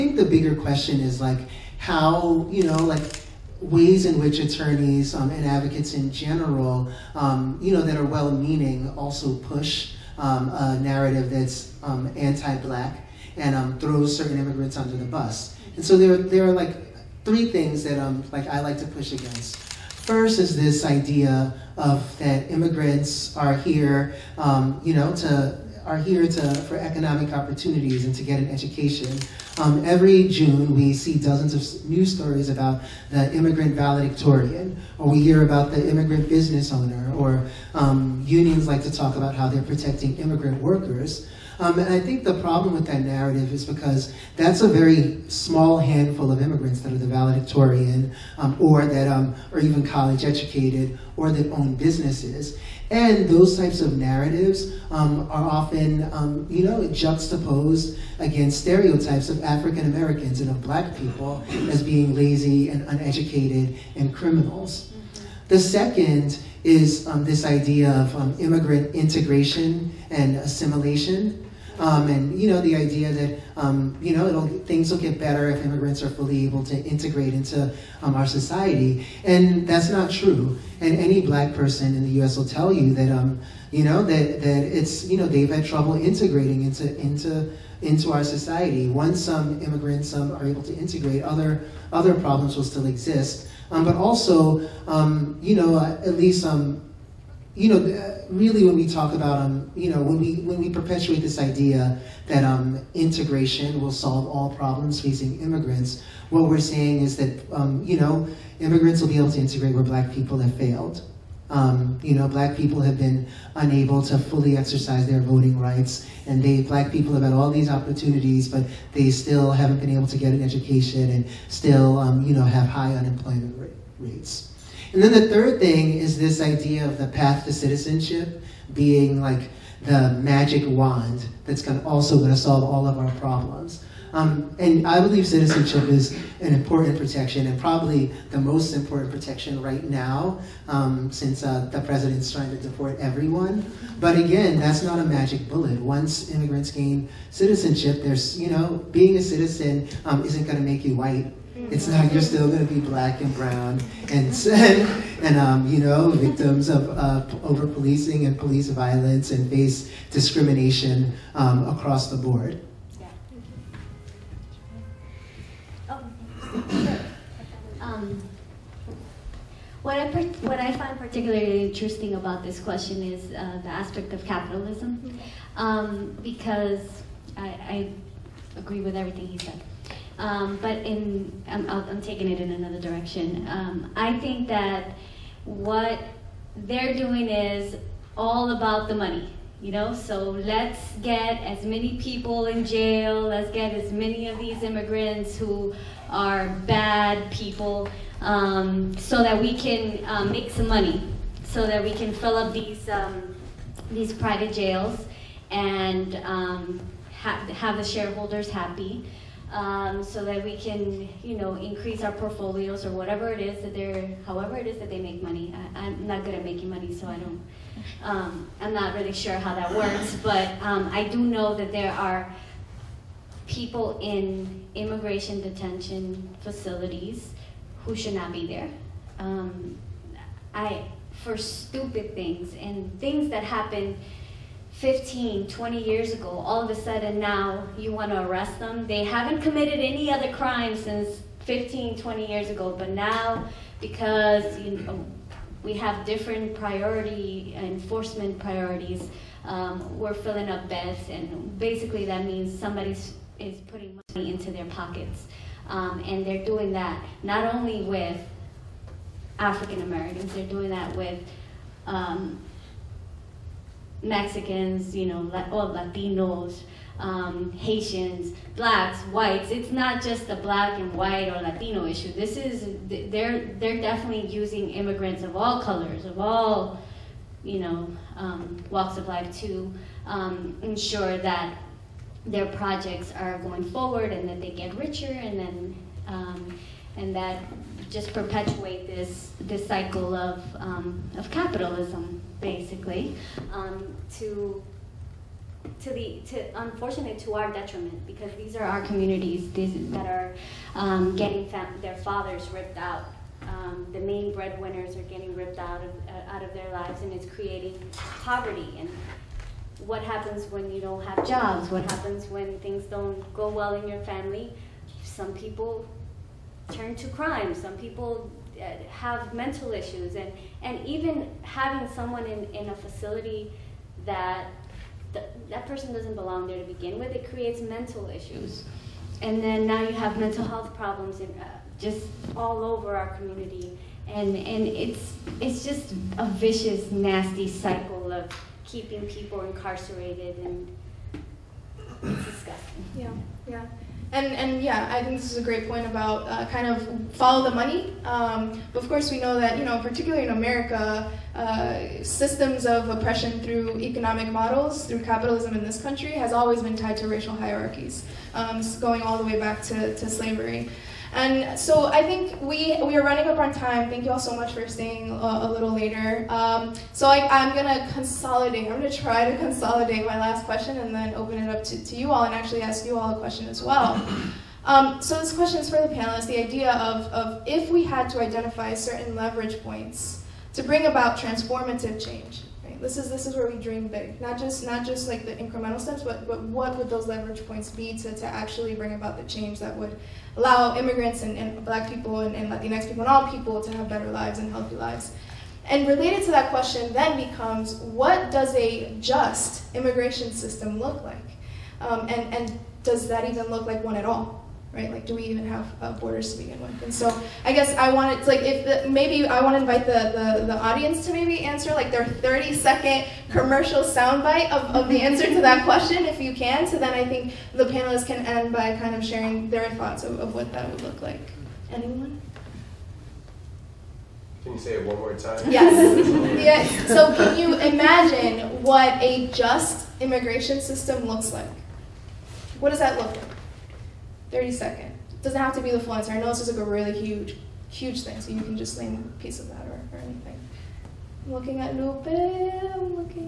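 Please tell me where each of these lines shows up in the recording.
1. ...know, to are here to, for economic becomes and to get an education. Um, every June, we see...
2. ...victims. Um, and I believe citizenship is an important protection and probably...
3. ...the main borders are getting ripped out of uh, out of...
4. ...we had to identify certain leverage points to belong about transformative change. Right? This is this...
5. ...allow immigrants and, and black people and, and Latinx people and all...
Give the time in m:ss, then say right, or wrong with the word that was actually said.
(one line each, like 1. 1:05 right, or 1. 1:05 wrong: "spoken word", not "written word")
1. 0:24 wrong: "opportunities", not "becomes"
2. 2:13 wrong: "problems", not "victims"
3. 5:03 wrong: "breadwinners", not "borders"
4. 6:17 wrong: "bring", not "belong"
5. 6:30 right.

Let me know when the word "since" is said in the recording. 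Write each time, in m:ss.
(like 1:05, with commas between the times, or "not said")
2:21, 4:00.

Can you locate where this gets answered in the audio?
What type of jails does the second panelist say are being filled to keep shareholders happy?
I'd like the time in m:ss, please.
3:24.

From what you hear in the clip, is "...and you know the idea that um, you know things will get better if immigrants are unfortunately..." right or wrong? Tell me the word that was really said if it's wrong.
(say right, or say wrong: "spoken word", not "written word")
wrong: "fully", not "unfortunately".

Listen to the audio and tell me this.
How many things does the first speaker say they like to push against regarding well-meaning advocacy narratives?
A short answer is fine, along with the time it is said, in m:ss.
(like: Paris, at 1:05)
3, at 0:17.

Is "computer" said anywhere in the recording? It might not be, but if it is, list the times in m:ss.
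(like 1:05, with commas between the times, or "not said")
not said.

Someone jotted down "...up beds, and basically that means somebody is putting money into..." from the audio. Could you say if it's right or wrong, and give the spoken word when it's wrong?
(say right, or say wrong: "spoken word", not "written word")
right.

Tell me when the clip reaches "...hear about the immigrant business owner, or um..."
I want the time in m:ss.
0:35.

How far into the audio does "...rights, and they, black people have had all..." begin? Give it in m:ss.
1:55.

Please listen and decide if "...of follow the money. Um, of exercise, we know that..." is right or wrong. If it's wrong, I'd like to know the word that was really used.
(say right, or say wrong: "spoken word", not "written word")
wrong: "course", not "exercise".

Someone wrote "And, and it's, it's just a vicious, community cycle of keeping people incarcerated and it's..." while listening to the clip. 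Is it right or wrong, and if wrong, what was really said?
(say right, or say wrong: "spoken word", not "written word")
wrong: "nasty", not "community".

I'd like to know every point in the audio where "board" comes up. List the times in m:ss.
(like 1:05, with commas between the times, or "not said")
2:42.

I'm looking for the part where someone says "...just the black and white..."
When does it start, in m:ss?
4:30.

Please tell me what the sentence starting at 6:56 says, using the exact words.
So then I think the panelists can end by kind of sharing their thoughts of, of what that would look like.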